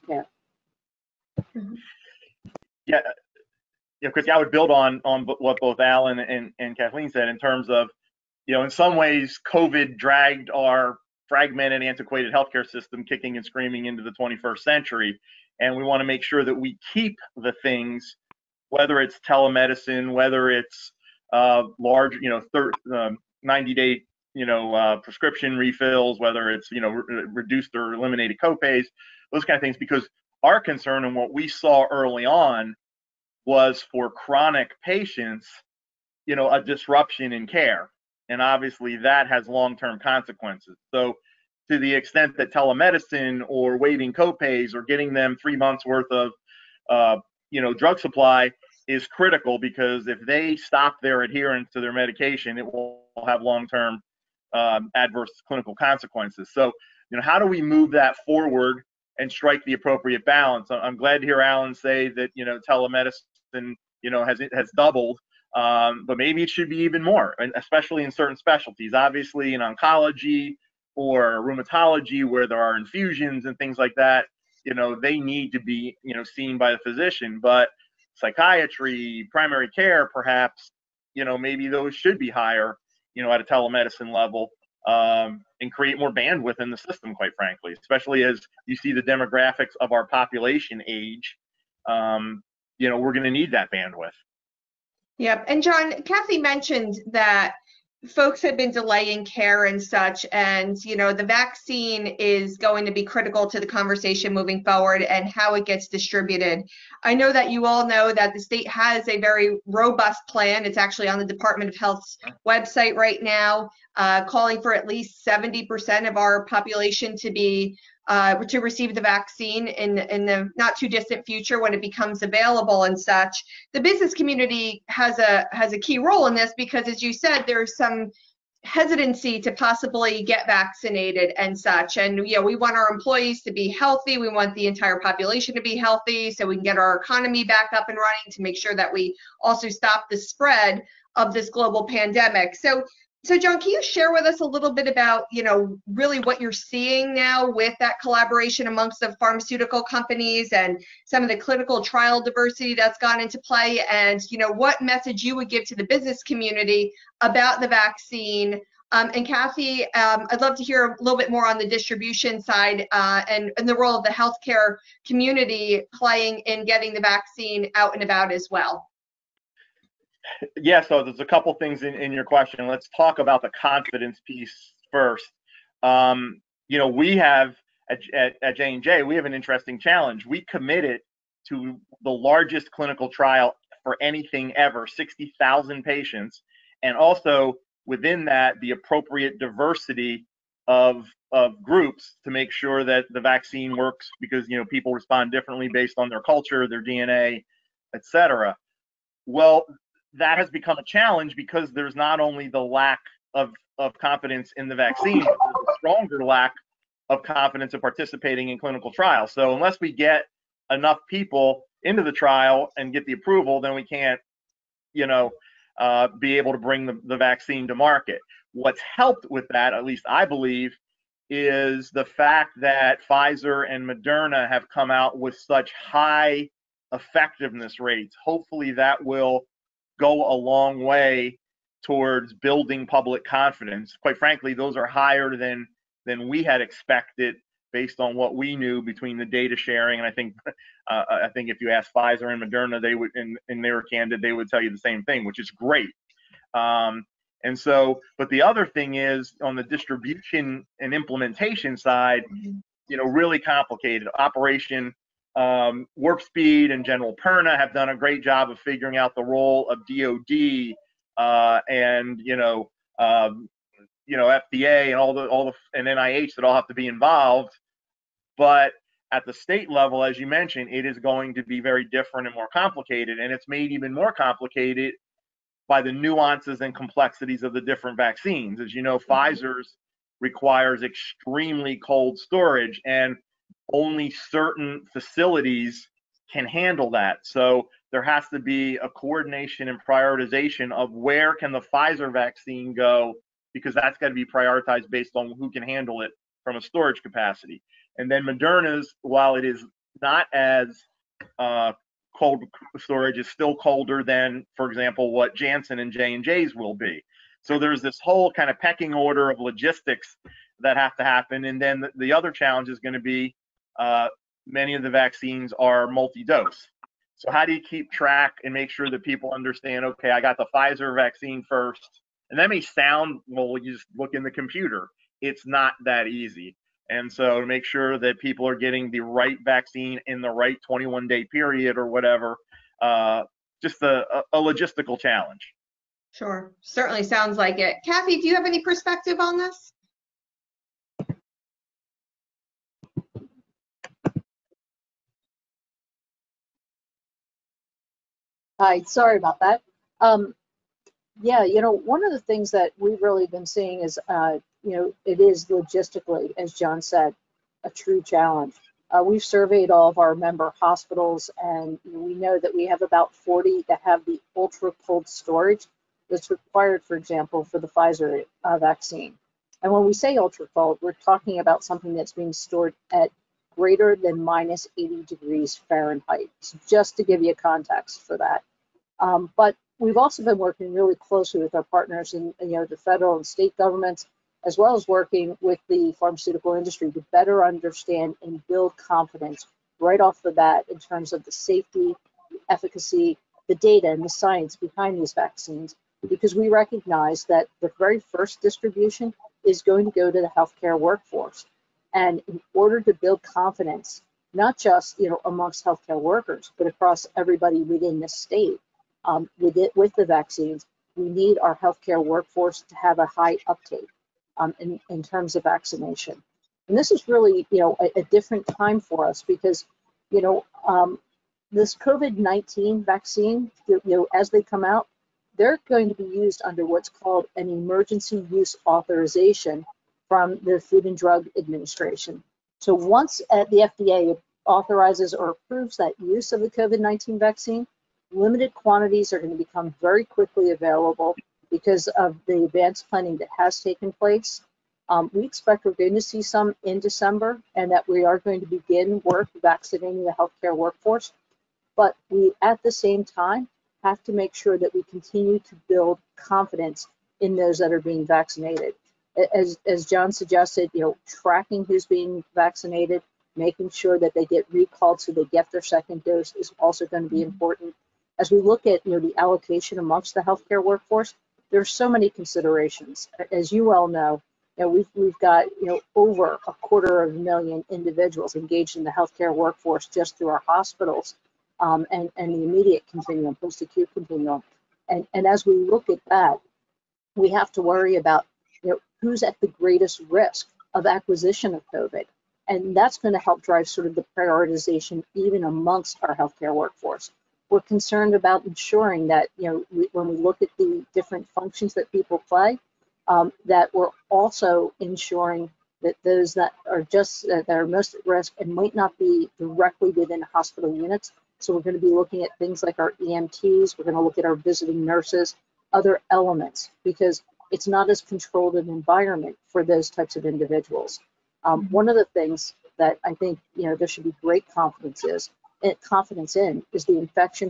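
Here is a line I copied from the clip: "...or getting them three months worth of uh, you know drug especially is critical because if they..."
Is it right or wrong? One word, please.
wrong.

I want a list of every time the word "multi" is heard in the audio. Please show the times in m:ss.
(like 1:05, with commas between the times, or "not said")
5:15.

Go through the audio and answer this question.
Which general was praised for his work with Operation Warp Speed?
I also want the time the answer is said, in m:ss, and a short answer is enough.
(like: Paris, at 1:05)
General Perna, at 4:16.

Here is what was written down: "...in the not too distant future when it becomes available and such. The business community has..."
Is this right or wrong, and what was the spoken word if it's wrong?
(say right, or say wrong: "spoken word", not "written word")
right.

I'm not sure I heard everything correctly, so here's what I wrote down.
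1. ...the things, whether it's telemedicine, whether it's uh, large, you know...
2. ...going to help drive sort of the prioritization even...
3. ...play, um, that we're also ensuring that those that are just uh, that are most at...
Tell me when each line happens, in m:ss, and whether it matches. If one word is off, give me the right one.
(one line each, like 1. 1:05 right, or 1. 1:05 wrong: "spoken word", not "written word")
1. 0:17 right
2. 8:12 right
3. 8:22 right.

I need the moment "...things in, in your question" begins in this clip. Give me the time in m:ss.
2:51.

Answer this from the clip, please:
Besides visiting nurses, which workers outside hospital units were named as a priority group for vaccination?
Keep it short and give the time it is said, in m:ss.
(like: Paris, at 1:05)
EMTs, at 8:33.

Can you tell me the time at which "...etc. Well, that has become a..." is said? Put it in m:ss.
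3:17.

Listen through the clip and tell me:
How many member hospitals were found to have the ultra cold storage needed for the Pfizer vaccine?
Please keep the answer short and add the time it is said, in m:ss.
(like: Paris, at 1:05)
40, at 6:02.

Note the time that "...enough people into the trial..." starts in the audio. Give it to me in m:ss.
3:30.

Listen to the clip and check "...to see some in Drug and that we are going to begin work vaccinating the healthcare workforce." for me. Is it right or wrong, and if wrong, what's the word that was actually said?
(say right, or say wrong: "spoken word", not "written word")
wrong: "December", not "Drug".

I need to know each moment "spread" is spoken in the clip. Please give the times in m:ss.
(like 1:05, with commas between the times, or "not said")
2:20.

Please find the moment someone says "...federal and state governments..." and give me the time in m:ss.
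6:22.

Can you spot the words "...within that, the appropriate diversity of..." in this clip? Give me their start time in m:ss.
3:07.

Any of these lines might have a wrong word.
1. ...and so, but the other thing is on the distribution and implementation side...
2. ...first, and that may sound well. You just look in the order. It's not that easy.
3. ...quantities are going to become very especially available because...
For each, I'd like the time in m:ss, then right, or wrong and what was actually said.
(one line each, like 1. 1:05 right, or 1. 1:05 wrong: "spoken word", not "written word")
1. 4:07 right
2. 5:21 wrong: "computer", not "order"
3. 7:18 wrong: "quickly", not "especially".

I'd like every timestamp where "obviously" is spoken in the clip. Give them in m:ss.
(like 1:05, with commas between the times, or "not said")
0:38, 1:08.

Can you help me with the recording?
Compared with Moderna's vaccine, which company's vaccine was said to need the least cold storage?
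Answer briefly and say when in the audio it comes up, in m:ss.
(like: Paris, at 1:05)
Janssen, at 5:05.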